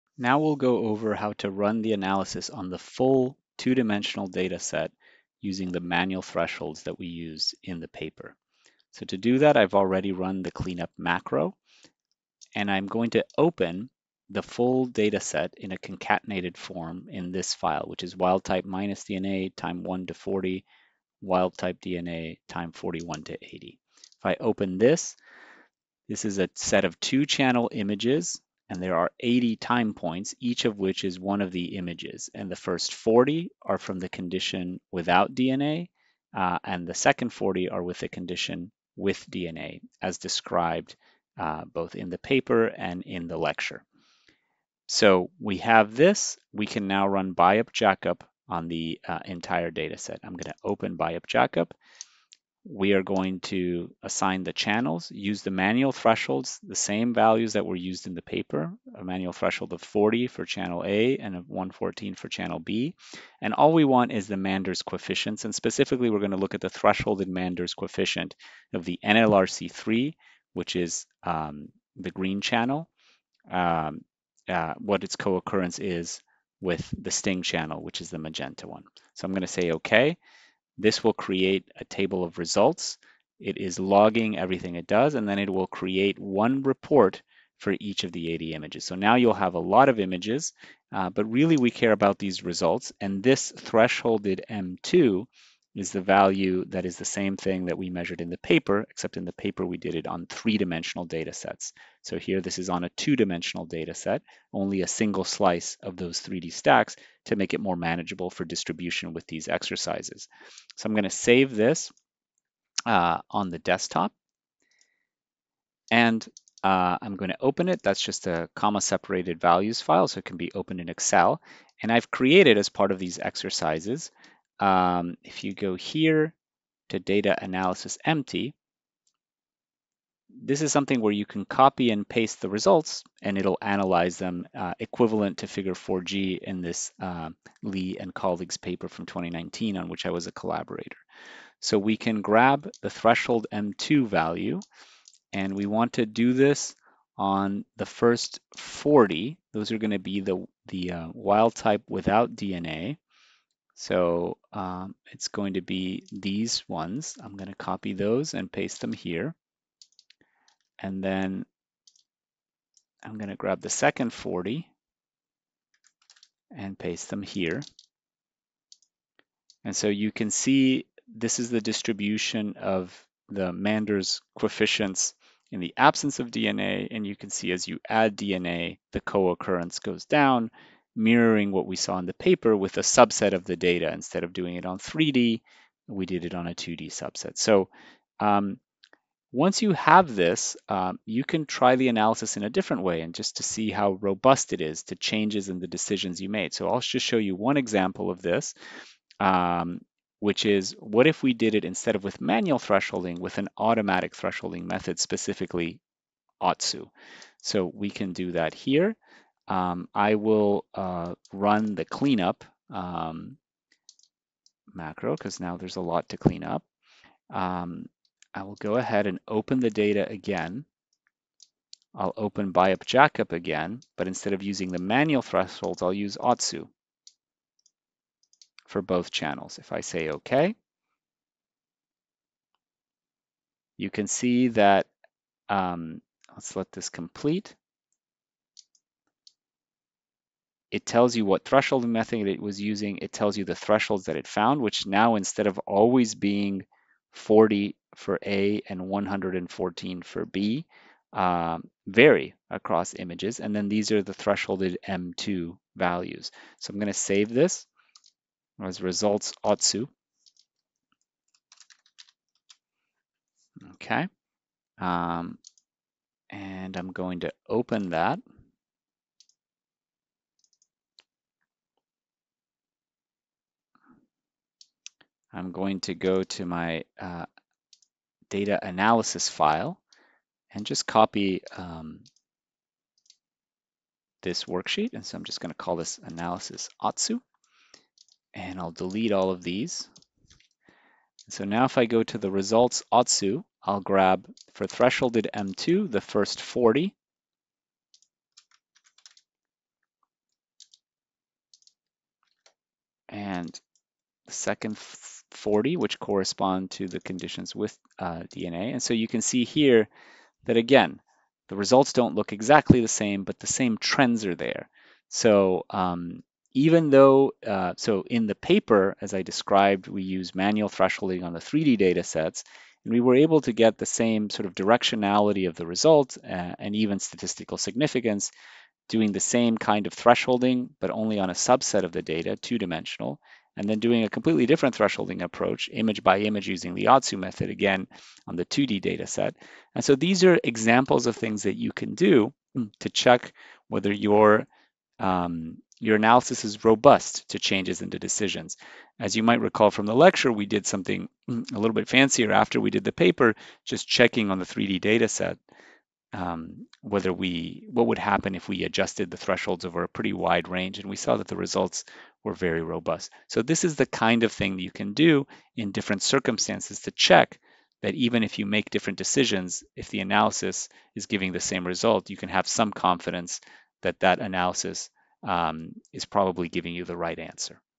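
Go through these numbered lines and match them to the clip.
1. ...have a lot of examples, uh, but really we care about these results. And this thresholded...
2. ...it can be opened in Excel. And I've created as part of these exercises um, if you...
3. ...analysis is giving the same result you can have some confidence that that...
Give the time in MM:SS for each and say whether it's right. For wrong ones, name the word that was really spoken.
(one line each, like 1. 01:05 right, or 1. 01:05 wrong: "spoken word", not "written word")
1. 01:29 wrong: "images", not "examples"
2. 02:00 right
3. 06:10 right.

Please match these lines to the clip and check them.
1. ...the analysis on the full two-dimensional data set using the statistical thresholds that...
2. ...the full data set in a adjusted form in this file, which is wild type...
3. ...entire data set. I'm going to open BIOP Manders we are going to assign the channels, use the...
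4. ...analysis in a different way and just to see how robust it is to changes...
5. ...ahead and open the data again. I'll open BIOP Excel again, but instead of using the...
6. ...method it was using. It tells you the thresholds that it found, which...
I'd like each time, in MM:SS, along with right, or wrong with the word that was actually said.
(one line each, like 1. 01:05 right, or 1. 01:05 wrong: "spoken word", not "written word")
1. 00:01 wrong: "manual", not "statistical"
2. 00:14 wrong: "concatenated", not "adjusted"
3. 00:49 wrong: "JACoP", not "Manders"
4. 03:11 right
5. 03:38 wrong: "JACoP", not "Excel"
6. 04:01 right.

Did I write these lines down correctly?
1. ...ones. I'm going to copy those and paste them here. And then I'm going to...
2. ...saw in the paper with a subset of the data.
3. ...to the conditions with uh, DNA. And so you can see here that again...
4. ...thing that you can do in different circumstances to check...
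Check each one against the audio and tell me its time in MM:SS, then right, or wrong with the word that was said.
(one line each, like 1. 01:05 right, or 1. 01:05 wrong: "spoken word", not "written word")
1. 02:36 right
2. 03:01 right
3. 05:06 right
4. 06:04 right.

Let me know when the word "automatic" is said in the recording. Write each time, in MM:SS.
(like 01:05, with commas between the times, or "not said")
03:23.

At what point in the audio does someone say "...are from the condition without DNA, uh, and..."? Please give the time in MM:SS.
00:33.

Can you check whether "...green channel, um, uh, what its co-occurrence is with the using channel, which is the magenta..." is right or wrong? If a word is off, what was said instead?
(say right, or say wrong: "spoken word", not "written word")
wrong: "sting", not "using".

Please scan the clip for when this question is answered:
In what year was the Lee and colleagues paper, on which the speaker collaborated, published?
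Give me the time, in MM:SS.
02:19.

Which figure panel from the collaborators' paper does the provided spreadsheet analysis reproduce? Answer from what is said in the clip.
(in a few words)
Figure 4G.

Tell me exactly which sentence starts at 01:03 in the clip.
And all we want is the Manders coefficients.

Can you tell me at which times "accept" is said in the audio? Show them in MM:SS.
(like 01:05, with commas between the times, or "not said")
not said.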